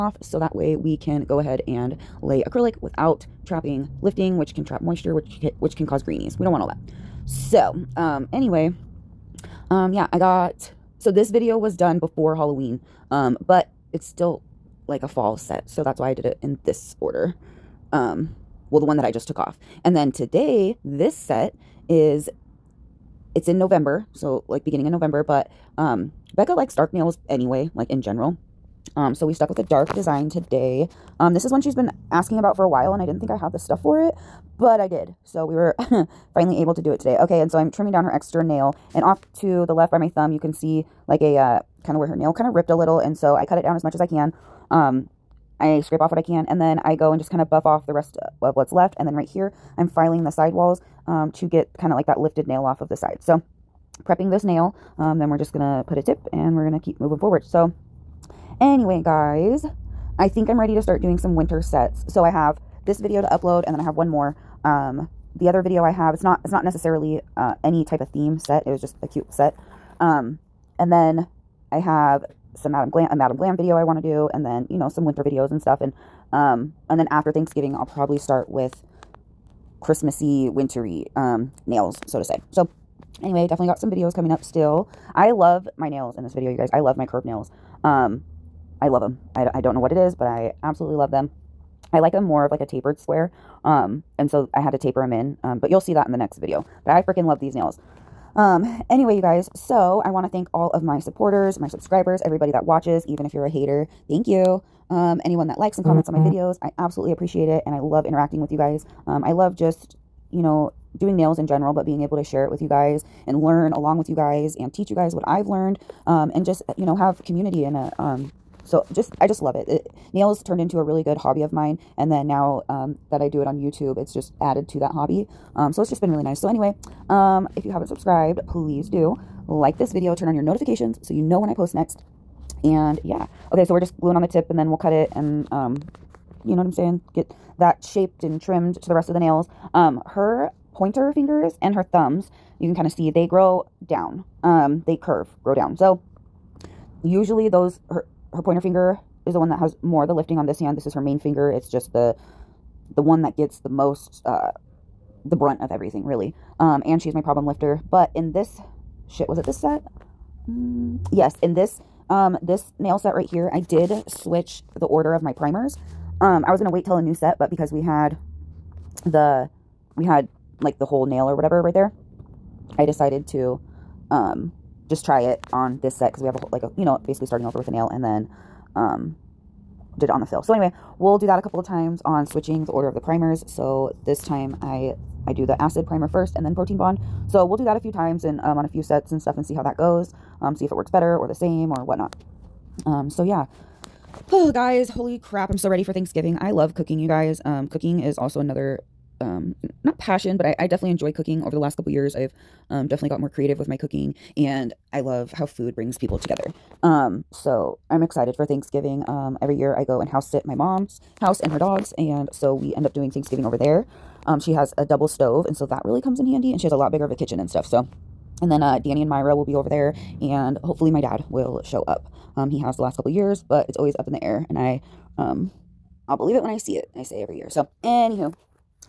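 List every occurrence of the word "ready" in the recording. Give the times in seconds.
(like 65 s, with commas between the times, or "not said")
60 s, 195 s.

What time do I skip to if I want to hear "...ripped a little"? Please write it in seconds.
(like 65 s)
42 s.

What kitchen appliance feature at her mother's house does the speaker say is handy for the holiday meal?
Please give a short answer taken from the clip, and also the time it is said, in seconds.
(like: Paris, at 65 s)
double stove, at 214 s.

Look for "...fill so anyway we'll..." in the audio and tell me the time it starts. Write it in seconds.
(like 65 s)
180 s.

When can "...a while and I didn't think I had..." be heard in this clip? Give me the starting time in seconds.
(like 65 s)
32 s.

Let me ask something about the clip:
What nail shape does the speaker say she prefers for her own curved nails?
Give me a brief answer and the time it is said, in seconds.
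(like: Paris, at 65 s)
tapered square, at 92 s.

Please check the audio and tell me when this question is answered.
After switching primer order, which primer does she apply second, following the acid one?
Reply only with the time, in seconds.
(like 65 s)
186 s.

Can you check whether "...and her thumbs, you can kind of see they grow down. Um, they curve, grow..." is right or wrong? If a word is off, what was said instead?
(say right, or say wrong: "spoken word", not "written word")
right.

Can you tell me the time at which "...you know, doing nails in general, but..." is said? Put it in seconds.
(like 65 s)
110 s.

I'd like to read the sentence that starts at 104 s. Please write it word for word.
Thank you um, anyone that likes and mm-hmm.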